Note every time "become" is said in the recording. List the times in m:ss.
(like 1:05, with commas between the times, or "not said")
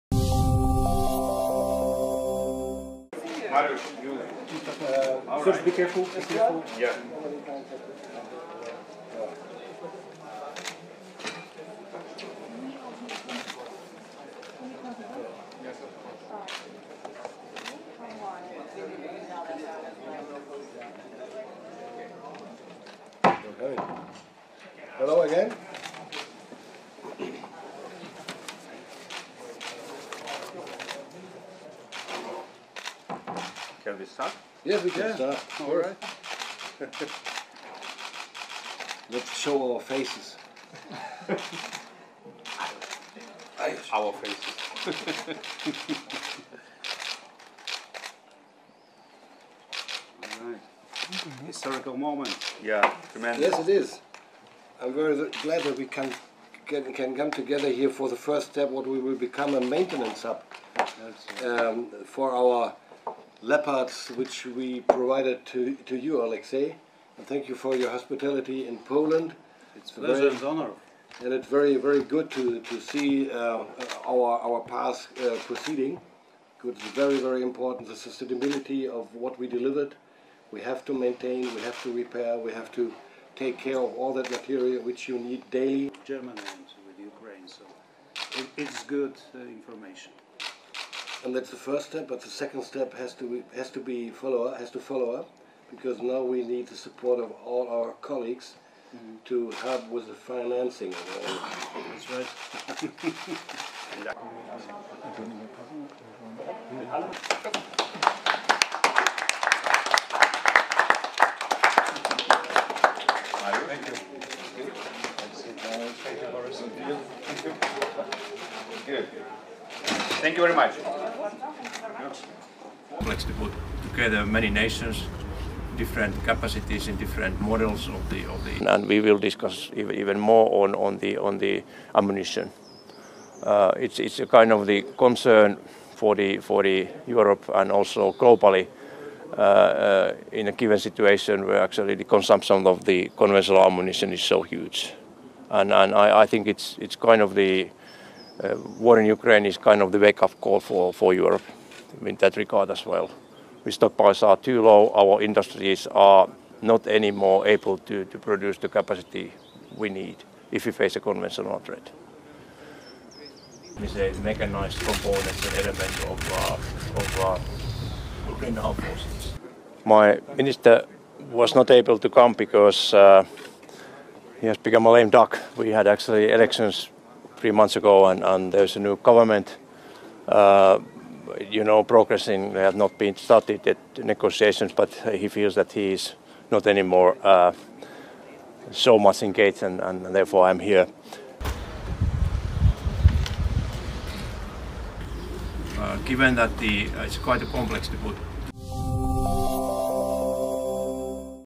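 0:59, 2:54.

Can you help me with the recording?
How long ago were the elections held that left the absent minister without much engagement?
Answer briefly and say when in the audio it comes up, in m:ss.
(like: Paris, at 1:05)
3 months ago, at 2:57.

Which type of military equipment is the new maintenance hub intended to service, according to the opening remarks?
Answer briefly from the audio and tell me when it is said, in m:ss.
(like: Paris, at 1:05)
Leopards, at 1:03.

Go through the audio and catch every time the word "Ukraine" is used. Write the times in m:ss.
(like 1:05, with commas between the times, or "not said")
1:26, 2:29, 2:48.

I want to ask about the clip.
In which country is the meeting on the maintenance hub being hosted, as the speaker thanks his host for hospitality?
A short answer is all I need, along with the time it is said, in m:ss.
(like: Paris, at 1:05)
Poland, at 1:08.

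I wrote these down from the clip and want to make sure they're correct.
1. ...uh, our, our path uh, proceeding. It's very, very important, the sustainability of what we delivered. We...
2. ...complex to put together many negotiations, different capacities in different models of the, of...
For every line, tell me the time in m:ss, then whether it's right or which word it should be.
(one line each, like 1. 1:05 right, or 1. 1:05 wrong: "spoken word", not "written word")
1. 1:13 right
2. 2:03 wrong: "nations", not "negotiations".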